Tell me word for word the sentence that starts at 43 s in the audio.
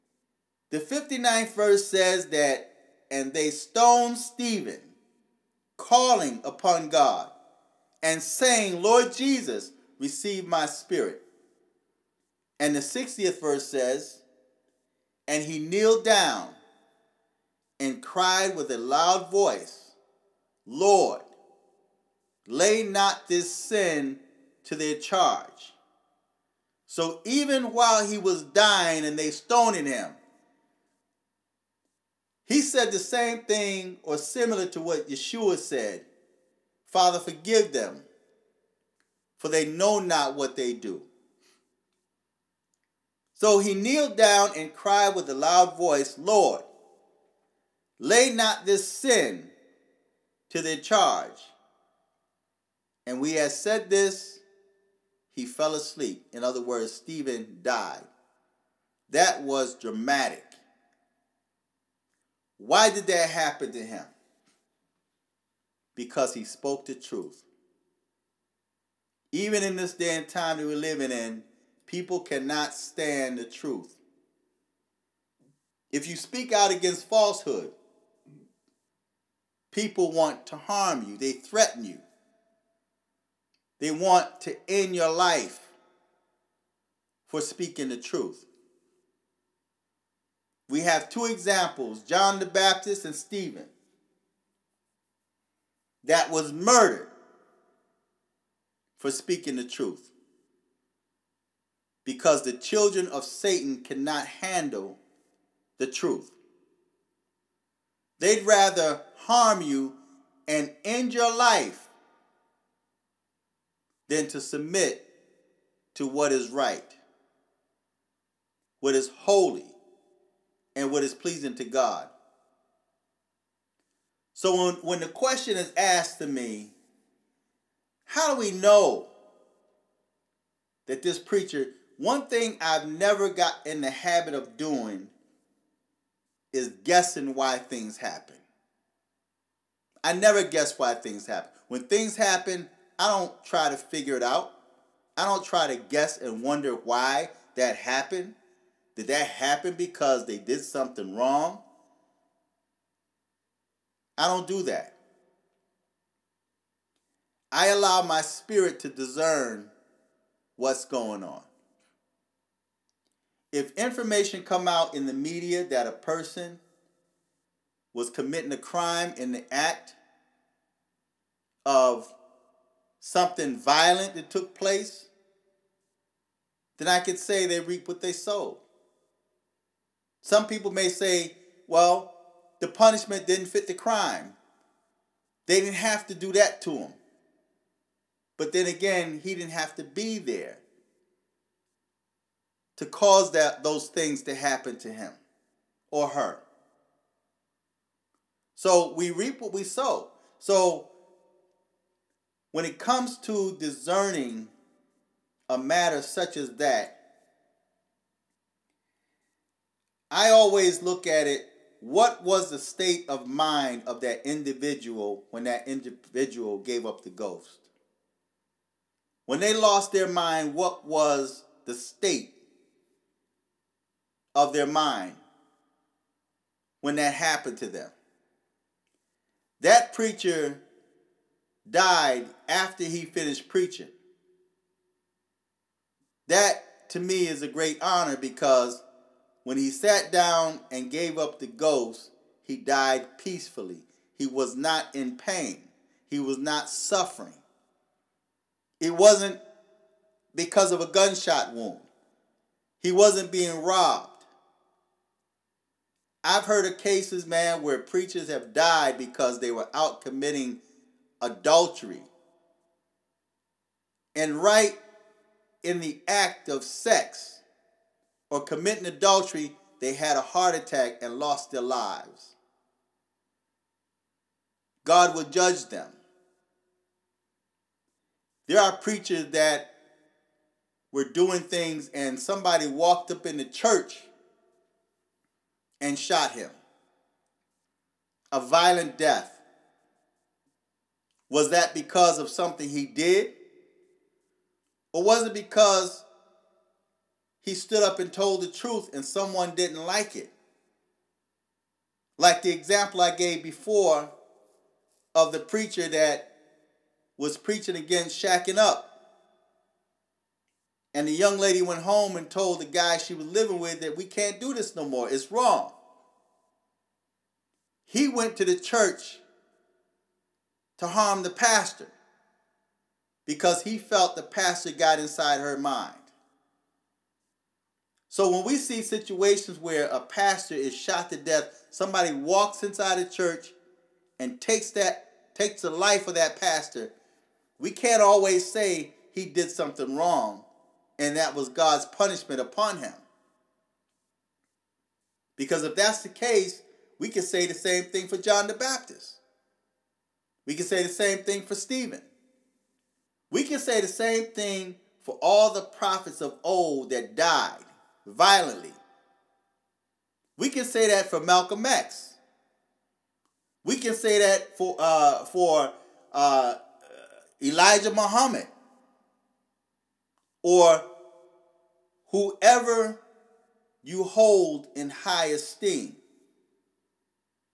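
So he kneeled down and cried with a loud voice, Lord, lay not this sin to their charge.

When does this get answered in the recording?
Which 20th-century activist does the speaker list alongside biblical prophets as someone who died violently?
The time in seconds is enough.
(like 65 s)
361 s.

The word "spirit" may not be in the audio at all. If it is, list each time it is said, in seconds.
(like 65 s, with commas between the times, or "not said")
10 s, 158 s.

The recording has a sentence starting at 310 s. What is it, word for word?
And the young lady went home and told the guy she was living with that we can't do this no more.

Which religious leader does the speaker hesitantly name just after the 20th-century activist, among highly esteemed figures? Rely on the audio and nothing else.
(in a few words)
Elijah Muhammad.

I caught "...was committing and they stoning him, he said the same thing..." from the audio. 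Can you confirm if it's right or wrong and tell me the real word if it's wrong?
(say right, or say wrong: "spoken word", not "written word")
wrong: "dying", not "committing".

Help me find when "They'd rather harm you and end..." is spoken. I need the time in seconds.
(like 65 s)
108 s.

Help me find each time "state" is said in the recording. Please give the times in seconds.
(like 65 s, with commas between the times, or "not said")
212 s, 221 s.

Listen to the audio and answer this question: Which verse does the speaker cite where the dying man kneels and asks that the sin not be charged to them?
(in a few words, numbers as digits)
60th.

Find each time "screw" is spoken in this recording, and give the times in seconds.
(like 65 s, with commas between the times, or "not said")
not said.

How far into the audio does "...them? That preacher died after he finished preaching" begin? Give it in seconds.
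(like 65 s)
227 s.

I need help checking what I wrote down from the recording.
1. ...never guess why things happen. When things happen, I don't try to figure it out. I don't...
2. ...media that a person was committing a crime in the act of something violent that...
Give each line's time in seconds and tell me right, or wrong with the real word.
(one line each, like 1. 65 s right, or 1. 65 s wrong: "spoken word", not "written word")
1. 140 s right
2. 165 s right.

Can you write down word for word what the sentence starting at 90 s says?
We have two examples John the Baptist and Stephen that was murdered for speaking the truth.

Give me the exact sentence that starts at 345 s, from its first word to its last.
Because if that's the case, we can say the same thing for John the Baptist.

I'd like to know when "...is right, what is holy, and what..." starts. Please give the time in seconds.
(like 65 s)
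116 s.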